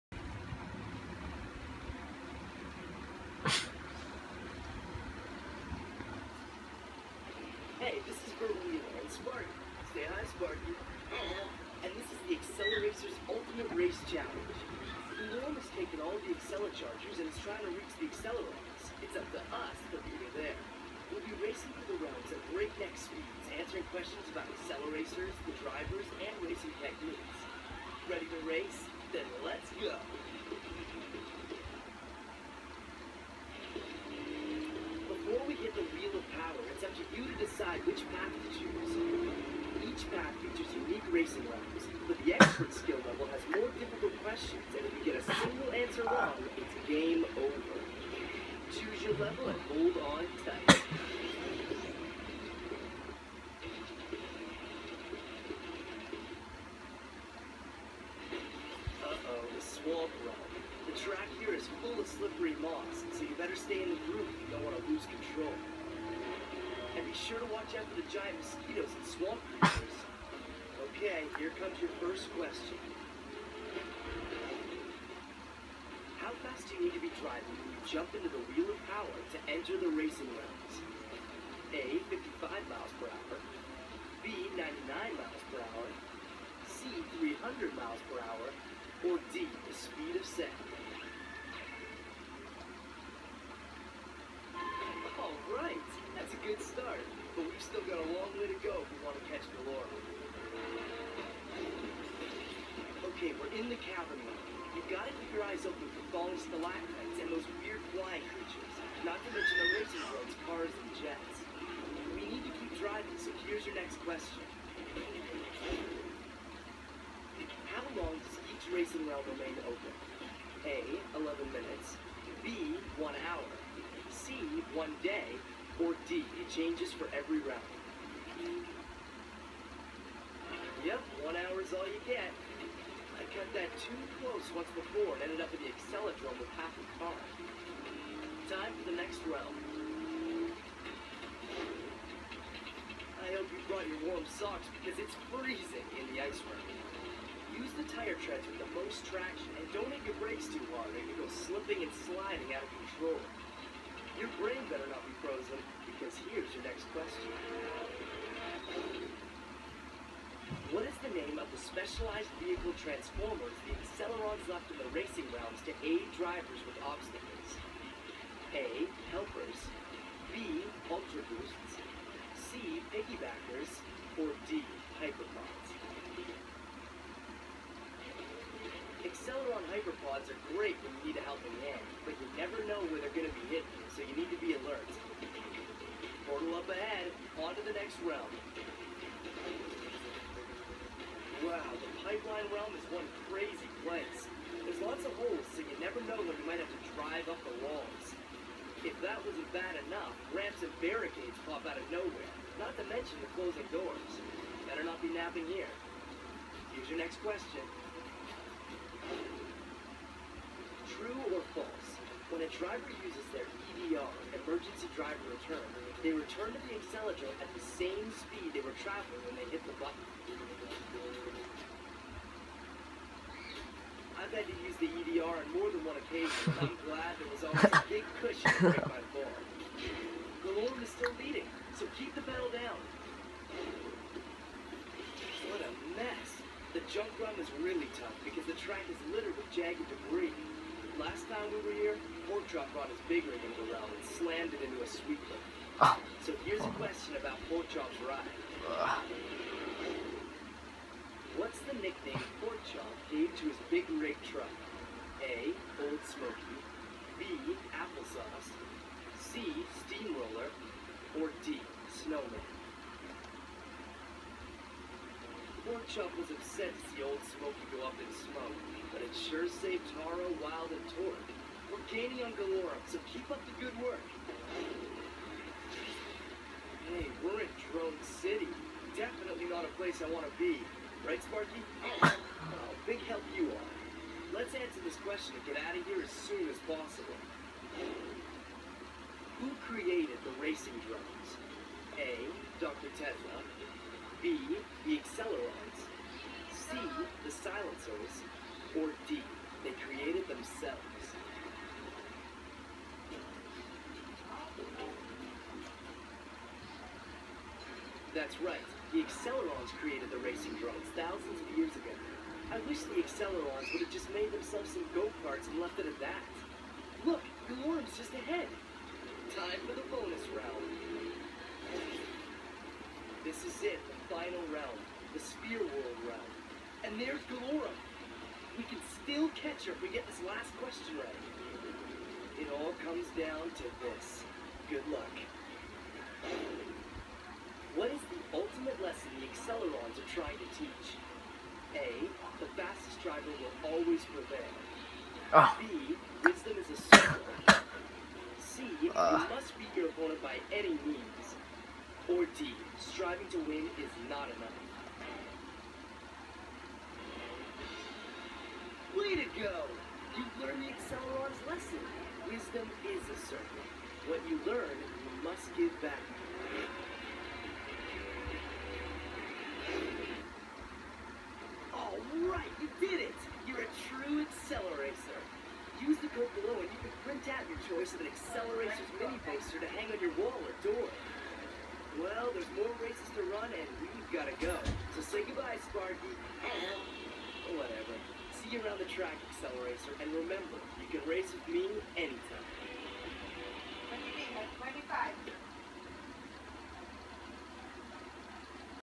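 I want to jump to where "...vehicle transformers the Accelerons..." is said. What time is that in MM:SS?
02:42.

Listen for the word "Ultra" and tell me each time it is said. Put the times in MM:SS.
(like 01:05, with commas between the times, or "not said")
02:50.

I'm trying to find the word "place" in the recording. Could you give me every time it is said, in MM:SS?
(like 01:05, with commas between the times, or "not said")
03:13, 04:39.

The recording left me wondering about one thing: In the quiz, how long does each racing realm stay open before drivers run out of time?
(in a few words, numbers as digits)
1 hour.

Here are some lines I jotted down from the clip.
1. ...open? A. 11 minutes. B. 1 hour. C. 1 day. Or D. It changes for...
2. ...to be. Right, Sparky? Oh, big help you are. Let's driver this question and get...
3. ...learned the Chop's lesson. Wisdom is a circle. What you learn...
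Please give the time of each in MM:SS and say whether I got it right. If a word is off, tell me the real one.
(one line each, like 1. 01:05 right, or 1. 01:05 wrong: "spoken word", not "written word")
1. 01:59 right
2. 04:40 wrong: "answer", not "driver"
3. 06:00 wrong: "Acceleron", not "Chop".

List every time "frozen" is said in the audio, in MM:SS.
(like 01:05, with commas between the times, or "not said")
02:35.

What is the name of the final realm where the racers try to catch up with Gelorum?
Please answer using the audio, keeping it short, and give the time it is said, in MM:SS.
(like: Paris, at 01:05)
Sphere World, at 05:25.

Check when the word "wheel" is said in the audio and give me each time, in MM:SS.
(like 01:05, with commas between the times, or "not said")
00:35, 01:18.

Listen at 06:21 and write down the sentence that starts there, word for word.
Well, there's more races to run and we've got to go.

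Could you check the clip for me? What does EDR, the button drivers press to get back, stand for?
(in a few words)
Emergency driver return.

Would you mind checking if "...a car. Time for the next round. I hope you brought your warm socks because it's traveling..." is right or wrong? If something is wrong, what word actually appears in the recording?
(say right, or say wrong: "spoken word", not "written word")
wrong: "freezing", not "traveling".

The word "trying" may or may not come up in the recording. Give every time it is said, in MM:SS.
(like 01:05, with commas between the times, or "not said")
00:17, 05:40.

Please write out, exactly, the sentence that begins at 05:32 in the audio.
It all comes down to this.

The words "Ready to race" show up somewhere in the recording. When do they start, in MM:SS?
00:28.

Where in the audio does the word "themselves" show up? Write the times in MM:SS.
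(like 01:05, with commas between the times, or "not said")
05:00, 05:14.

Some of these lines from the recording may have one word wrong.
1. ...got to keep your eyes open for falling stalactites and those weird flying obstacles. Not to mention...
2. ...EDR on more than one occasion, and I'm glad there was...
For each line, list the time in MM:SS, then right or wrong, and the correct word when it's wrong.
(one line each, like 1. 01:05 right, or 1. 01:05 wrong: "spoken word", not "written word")
1. 01:44 wrong: "creatures", not "obstacles"
2. 03:44 right.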